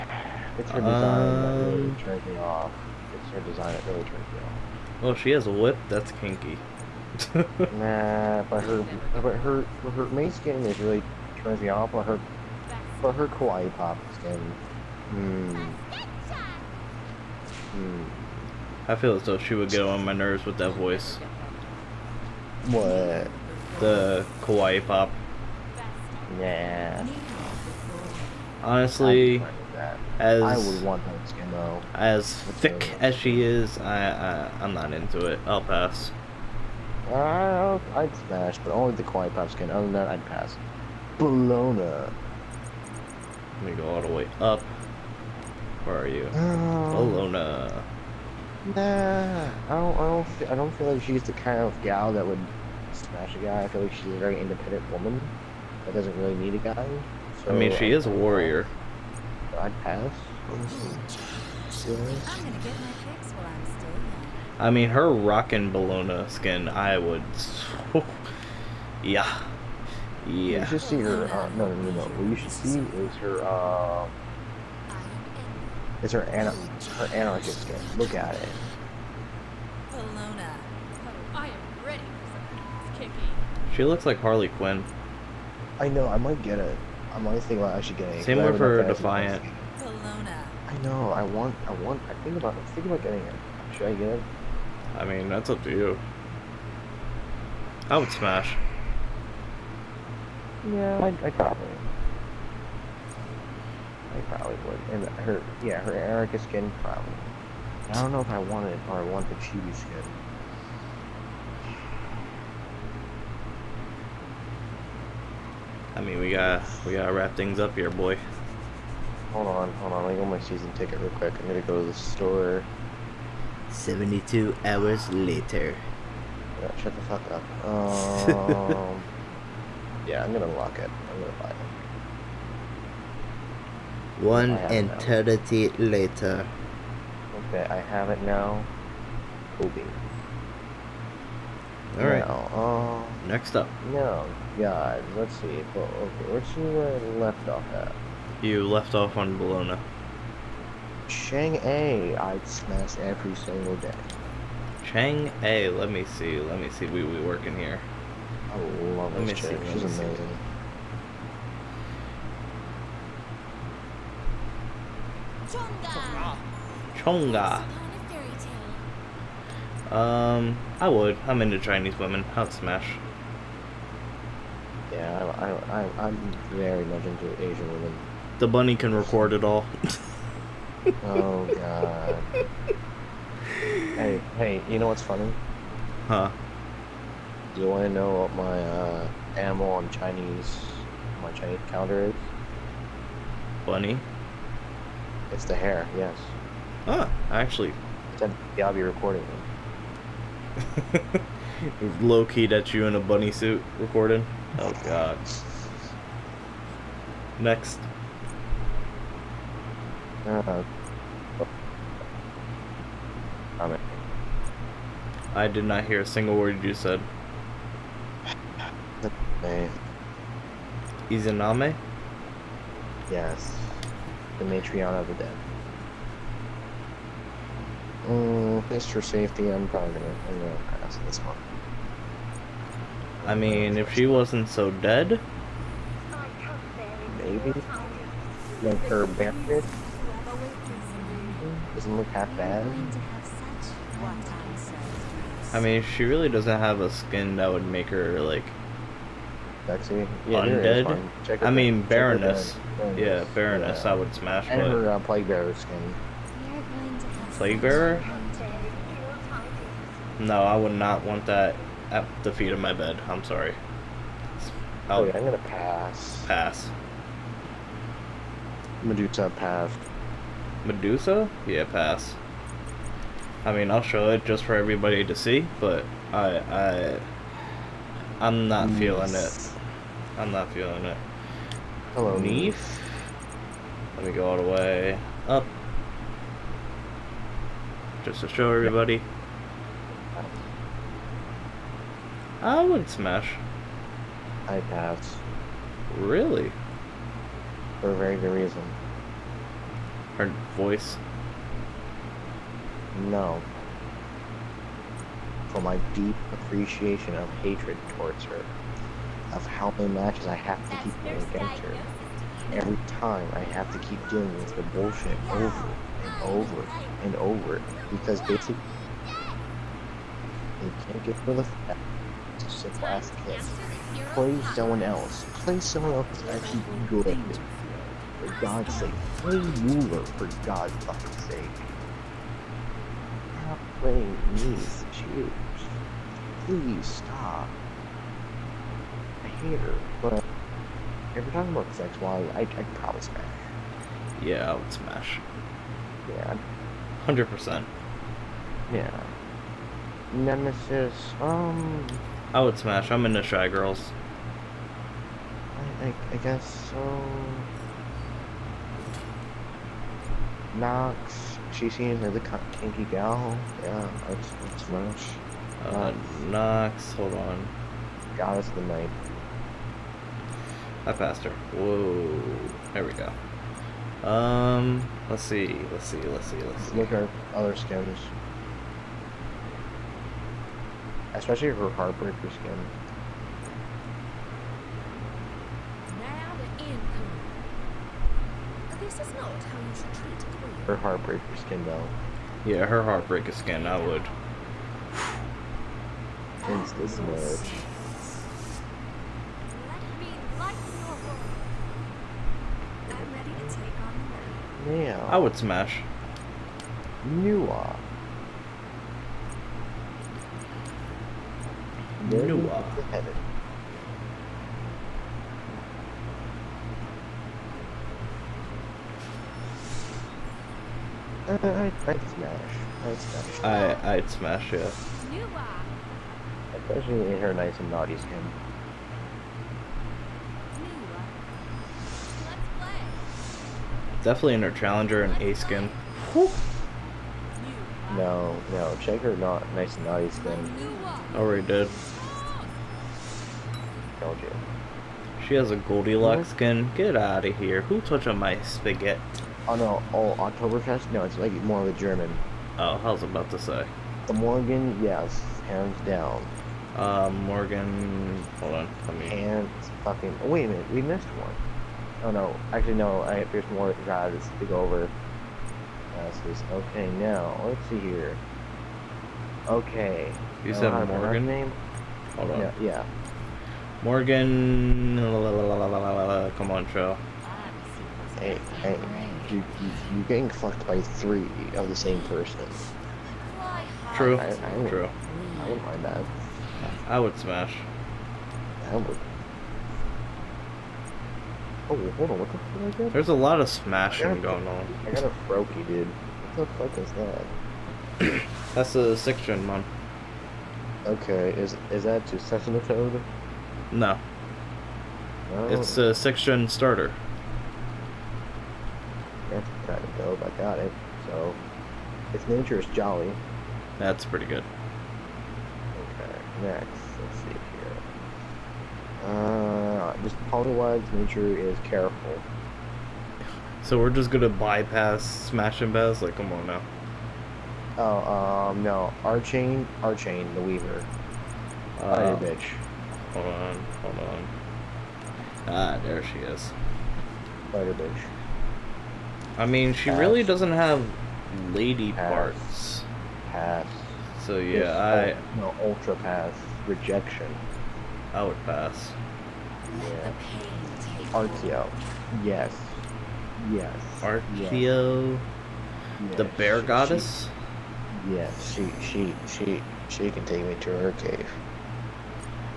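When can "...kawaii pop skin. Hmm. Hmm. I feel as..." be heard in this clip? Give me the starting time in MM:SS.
00:13.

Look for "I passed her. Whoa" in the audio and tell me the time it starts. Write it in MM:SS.
06:10.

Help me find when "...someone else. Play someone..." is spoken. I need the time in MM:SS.
05:24.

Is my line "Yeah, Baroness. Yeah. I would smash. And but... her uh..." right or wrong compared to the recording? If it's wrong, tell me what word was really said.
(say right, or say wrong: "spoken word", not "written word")
right.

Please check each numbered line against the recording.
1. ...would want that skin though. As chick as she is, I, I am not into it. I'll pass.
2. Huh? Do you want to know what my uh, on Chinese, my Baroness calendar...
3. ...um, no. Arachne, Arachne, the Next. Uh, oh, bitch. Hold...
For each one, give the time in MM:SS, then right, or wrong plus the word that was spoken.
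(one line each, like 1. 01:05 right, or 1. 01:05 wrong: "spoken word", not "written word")
1. 00:30 wrong: "thick", not "chick"
2. 03:06 wrong: "Chinese", not "Baroness"
3. 08:48 wrong: "Weaver", not "Next".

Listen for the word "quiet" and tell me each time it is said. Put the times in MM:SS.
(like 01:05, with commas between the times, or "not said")
00:39.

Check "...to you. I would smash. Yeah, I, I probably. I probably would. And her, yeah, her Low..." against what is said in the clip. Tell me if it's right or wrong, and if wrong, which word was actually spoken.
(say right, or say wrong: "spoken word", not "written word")
wrong: "Erica", not "Low".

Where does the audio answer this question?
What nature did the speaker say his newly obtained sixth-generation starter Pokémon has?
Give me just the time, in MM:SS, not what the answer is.
08:32.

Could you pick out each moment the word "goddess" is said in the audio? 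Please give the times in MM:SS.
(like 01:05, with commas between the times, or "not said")
06:08, 09:16.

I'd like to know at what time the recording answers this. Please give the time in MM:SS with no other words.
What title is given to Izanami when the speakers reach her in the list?
03:44.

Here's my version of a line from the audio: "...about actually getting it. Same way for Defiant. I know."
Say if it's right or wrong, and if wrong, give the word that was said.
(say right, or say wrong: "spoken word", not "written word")
right.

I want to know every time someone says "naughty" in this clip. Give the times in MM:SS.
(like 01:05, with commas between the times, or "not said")
07:07, 07:19.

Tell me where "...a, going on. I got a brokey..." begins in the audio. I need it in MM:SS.
08:14.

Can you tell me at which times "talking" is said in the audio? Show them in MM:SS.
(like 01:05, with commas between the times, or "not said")
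05:41.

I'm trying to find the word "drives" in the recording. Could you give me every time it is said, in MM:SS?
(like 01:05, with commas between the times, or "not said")
07:43.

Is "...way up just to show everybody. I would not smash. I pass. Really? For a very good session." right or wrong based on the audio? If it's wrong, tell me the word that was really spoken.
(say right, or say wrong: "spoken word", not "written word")
wrong: "reason", not "session".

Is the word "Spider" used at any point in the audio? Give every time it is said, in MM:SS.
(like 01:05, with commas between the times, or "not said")
08:57.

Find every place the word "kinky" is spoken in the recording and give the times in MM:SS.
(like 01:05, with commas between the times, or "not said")
00:06, 06:02.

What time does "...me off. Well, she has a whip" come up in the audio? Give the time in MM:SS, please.
00:04.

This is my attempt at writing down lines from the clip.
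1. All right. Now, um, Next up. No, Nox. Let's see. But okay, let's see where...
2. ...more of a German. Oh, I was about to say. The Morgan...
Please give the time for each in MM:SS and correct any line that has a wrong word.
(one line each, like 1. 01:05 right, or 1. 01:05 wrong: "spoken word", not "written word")
1. 02:21 wrong: "God", not "Nox"
2. 07:31 right.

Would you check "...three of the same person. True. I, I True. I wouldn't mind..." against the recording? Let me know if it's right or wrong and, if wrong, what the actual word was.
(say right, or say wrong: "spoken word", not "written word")
right.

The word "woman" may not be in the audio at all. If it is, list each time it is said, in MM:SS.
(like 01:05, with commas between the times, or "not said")
00:54.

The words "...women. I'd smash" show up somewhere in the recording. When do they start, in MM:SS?
02:51.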